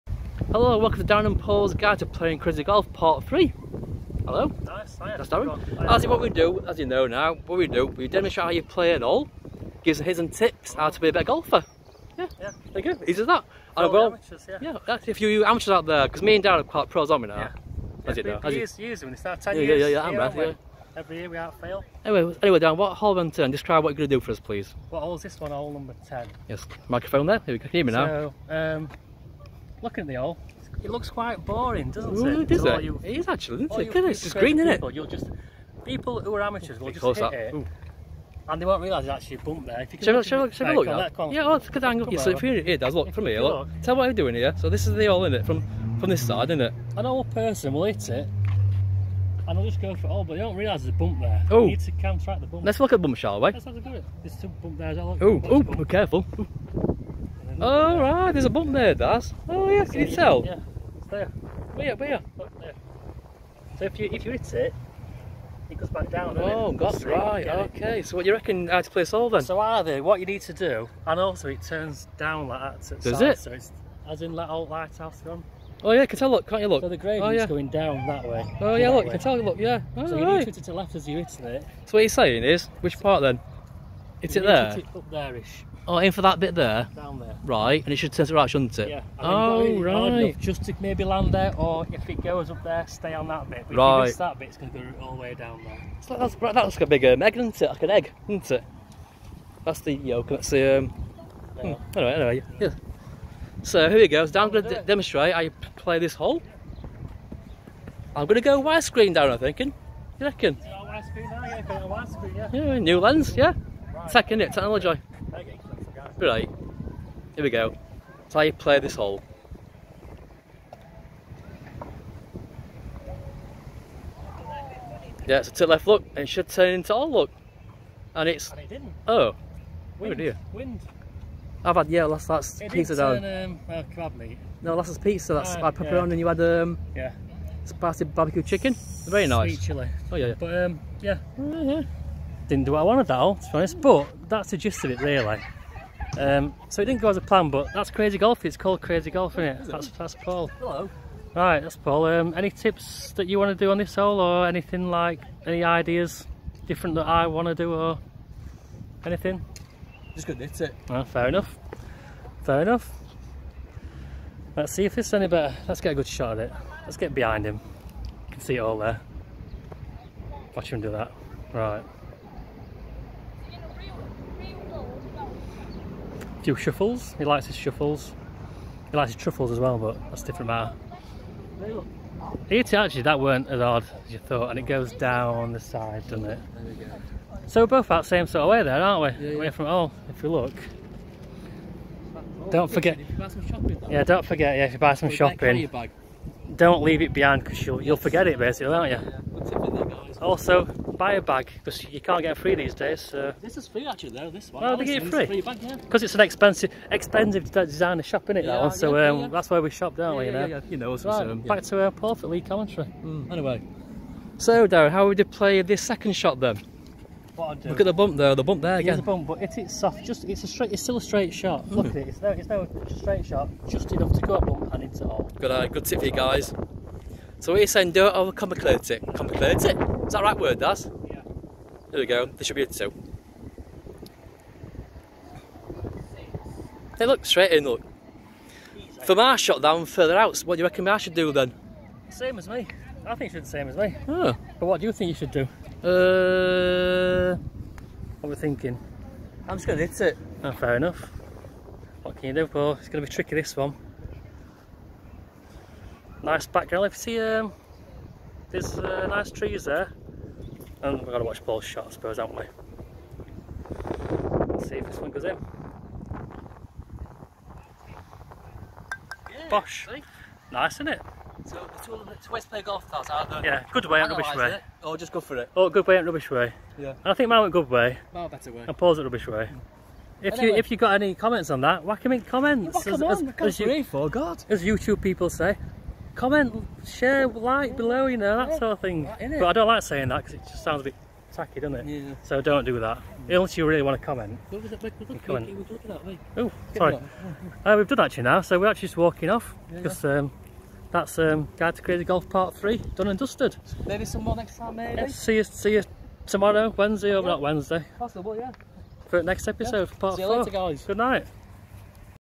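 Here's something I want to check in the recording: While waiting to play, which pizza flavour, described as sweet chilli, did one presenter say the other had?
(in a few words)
Spicy barbecue chicken.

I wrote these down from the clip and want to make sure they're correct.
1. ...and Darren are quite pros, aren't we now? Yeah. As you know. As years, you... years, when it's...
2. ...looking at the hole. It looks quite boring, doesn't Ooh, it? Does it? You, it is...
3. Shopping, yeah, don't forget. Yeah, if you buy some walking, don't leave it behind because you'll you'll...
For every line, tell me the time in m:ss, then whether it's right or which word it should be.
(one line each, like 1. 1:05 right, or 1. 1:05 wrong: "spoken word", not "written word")
1. 0:16 right
2. 0:29 right
3. 3:13 wrong: "shopping", not "walking".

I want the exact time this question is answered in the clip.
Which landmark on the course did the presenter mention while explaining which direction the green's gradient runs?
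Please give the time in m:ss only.
1:14.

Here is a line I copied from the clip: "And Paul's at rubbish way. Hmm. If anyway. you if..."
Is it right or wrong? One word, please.
right.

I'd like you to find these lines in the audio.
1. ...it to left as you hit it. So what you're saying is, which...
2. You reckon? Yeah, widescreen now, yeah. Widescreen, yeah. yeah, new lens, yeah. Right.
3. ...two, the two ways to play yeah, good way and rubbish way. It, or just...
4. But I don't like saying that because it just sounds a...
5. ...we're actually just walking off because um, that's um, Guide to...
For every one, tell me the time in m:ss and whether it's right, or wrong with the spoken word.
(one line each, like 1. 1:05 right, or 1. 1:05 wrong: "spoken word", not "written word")
1. 1:20 right
2. 1:50 right
3. 4:31 right
4. 4:49 right
5. 4:58 right.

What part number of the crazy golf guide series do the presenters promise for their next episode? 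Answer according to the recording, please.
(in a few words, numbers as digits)
Part 4.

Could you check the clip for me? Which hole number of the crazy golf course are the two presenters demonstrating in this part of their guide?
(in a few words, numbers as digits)
10.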